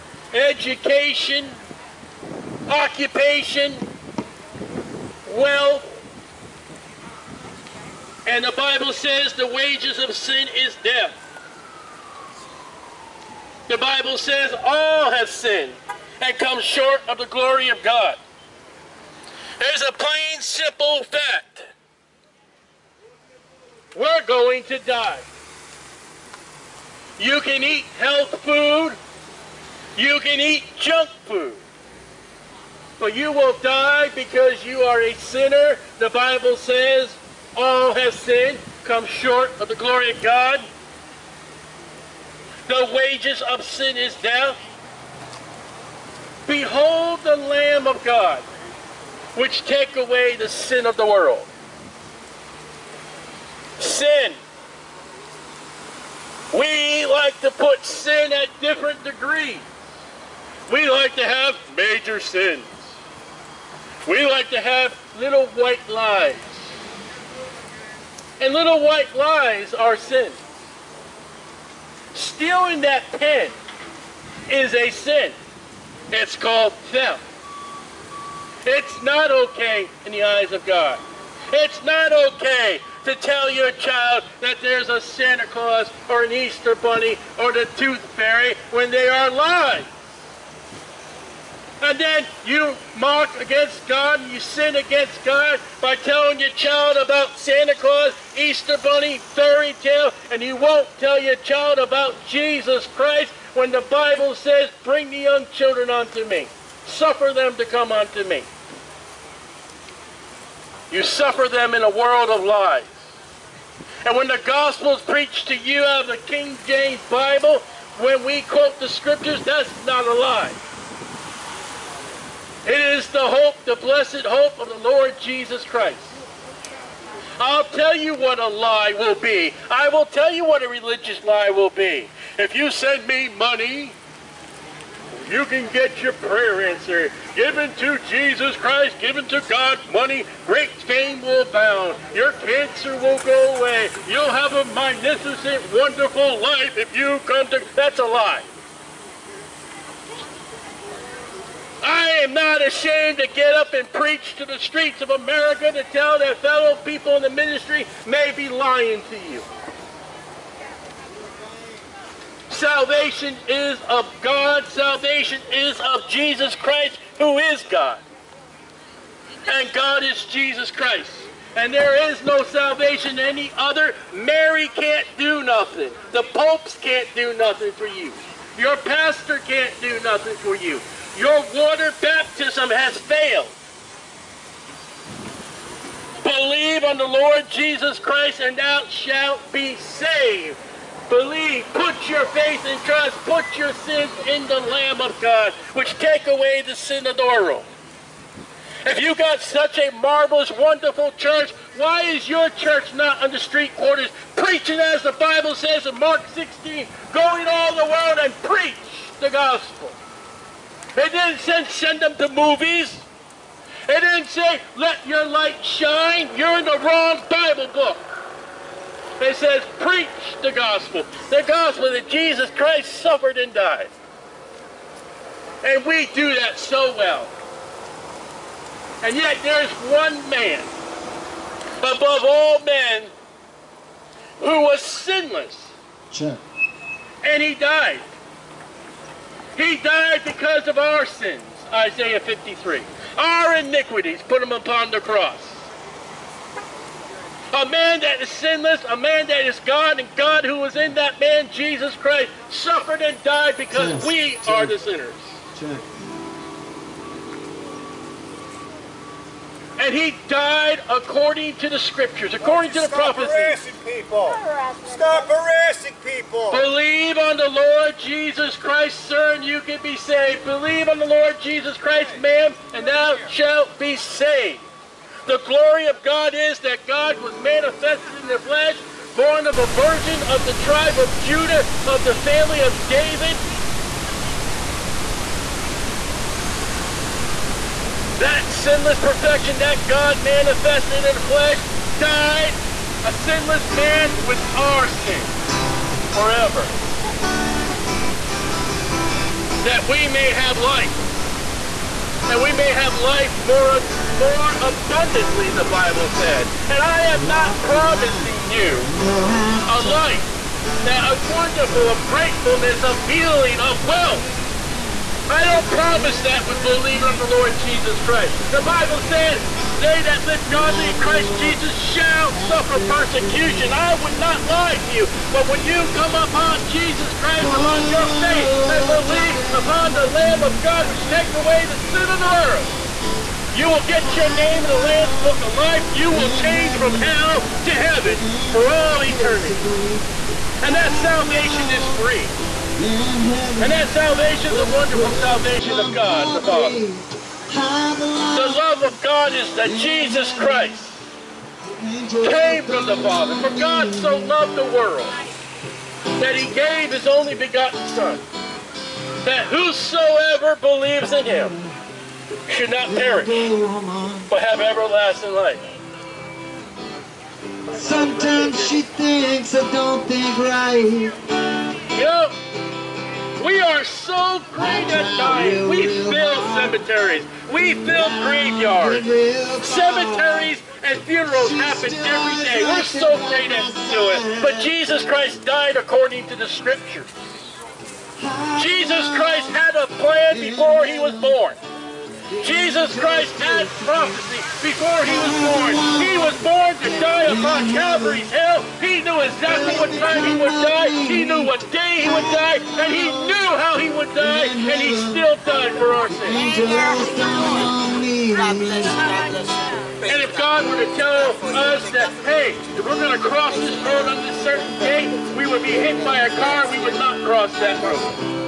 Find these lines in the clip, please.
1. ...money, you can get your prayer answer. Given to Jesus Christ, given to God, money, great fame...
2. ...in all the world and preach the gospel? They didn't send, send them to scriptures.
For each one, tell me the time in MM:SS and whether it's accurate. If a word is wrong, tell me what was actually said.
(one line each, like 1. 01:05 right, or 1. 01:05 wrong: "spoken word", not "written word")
1. 02:13 right
2. 03:27 wrong: "movies", not "scriptures".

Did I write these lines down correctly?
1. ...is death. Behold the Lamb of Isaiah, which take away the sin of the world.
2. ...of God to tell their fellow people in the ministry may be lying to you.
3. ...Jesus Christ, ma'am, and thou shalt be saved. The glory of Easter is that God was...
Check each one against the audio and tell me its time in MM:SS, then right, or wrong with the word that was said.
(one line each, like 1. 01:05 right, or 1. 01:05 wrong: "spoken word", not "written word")
1. 00:43 wrong: "God", not "Isaiah"
2. 02:34 wrong: "America", not "God"
3. 04:31 wrong: "God", not "Easter".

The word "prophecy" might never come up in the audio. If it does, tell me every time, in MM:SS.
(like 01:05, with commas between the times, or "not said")
04:23, 06:33.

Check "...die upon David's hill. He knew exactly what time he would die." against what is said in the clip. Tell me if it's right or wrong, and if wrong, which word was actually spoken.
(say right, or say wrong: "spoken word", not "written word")
wrong: "Calvary", not "David".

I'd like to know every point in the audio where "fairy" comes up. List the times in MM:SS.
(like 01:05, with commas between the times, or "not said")
01:28, 01:39.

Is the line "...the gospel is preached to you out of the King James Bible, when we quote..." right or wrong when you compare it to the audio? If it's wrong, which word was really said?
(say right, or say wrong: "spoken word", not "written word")
right.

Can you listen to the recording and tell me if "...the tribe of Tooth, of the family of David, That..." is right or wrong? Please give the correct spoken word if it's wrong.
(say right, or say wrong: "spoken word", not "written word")
wrong: "Judah", not "Tooth".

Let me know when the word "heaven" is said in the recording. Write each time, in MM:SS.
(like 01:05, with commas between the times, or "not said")
05:37.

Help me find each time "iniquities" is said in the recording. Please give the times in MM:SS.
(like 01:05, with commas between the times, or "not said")
04:03.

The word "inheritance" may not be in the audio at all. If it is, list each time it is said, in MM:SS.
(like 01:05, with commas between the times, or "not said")
not said.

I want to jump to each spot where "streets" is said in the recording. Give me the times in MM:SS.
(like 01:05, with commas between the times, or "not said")
02:34, 03:23.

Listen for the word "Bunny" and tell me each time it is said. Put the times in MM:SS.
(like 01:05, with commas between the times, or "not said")
01:26, 01:38.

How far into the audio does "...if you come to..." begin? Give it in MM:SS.
02:26.